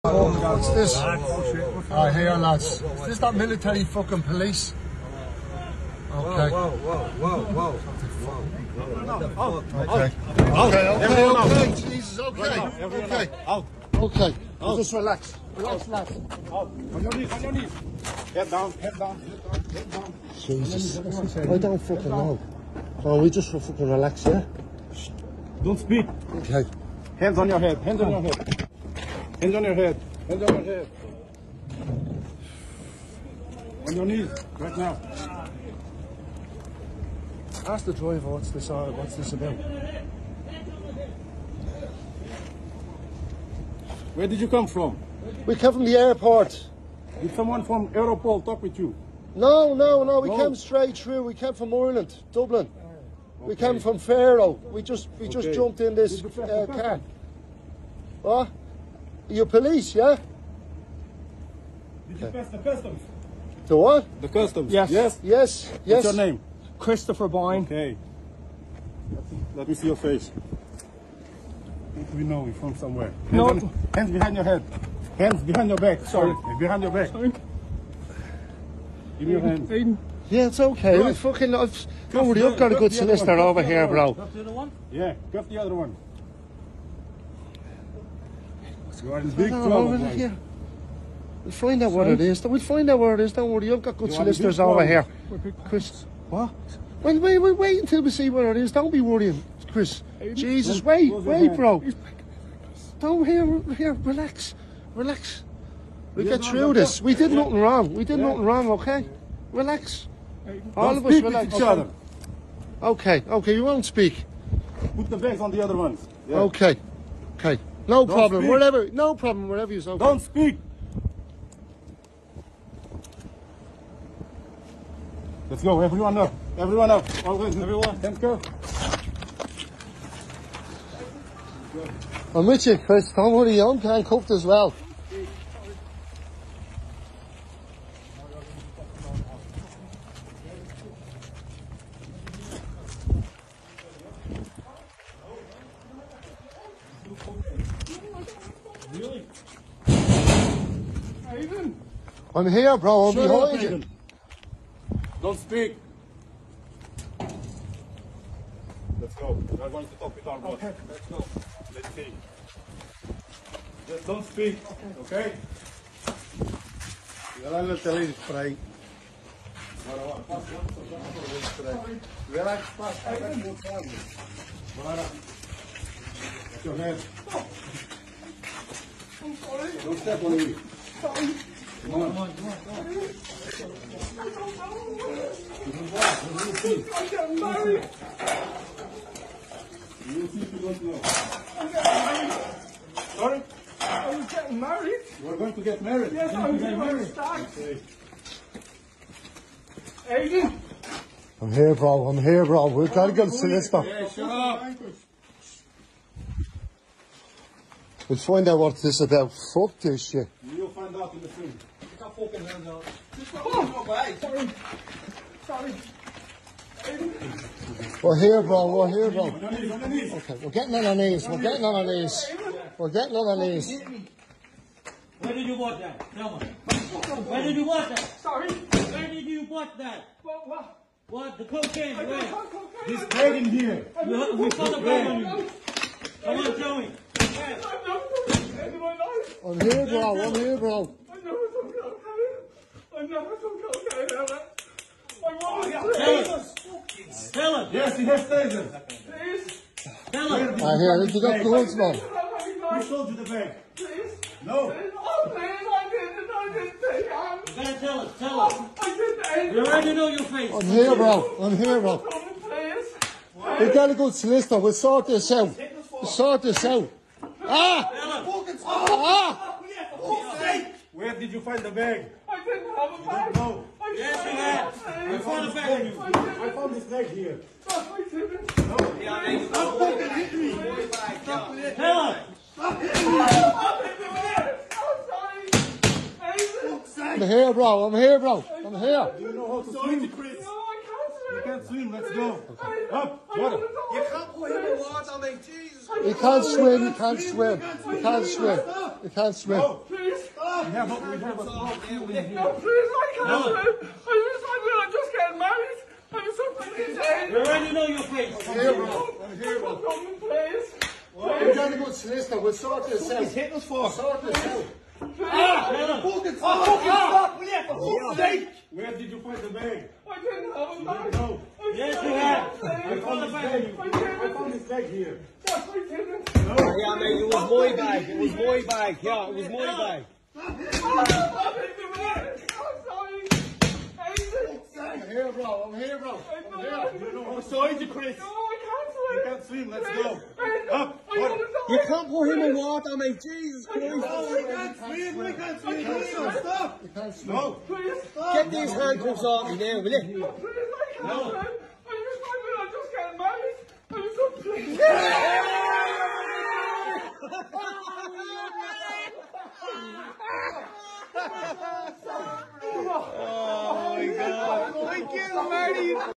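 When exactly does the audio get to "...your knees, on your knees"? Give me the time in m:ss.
0:17.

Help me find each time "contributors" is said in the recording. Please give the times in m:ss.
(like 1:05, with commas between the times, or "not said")
not said.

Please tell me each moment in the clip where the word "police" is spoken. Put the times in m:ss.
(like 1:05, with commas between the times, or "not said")
0:04, 0:59.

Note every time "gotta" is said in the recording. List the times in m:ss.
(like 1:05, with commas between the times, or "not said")
4:17, 4:23, 5:11.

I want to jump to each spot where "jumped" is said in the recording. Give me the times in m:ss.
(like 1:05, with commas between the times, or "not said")
0:55.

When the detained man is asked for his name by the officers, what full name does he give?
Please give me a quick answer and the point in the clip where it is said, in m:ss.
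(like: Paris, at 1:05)
Christopher Boyne, at 1:06.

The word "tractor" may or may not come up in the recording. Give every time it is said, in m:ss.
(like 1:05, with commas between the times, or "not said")
not said.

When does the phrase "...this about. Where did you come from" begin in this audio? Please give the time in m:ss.
0:39.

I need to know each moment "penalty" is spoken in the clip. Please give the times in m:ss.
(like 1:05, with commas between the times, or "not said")
not said.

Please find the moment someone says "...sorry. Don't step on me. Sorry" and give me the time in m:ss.
2:59.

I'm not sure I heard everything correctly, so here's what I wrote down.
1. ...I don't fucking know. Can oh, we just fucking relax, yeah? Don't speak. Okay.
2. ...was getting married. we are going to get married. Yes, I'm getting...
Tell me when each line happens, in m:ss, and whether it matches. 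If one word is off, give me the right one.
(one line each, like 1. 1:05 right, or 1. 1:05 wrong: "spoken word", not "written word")
1. 0:21 right
2. 3:14 right.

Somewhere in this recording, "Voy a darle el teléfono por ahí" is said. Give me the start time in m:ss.
2:47.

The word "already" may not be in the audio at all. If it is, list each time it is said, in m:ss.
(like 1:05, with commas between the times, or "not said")
1:22, 4:19, 5:07.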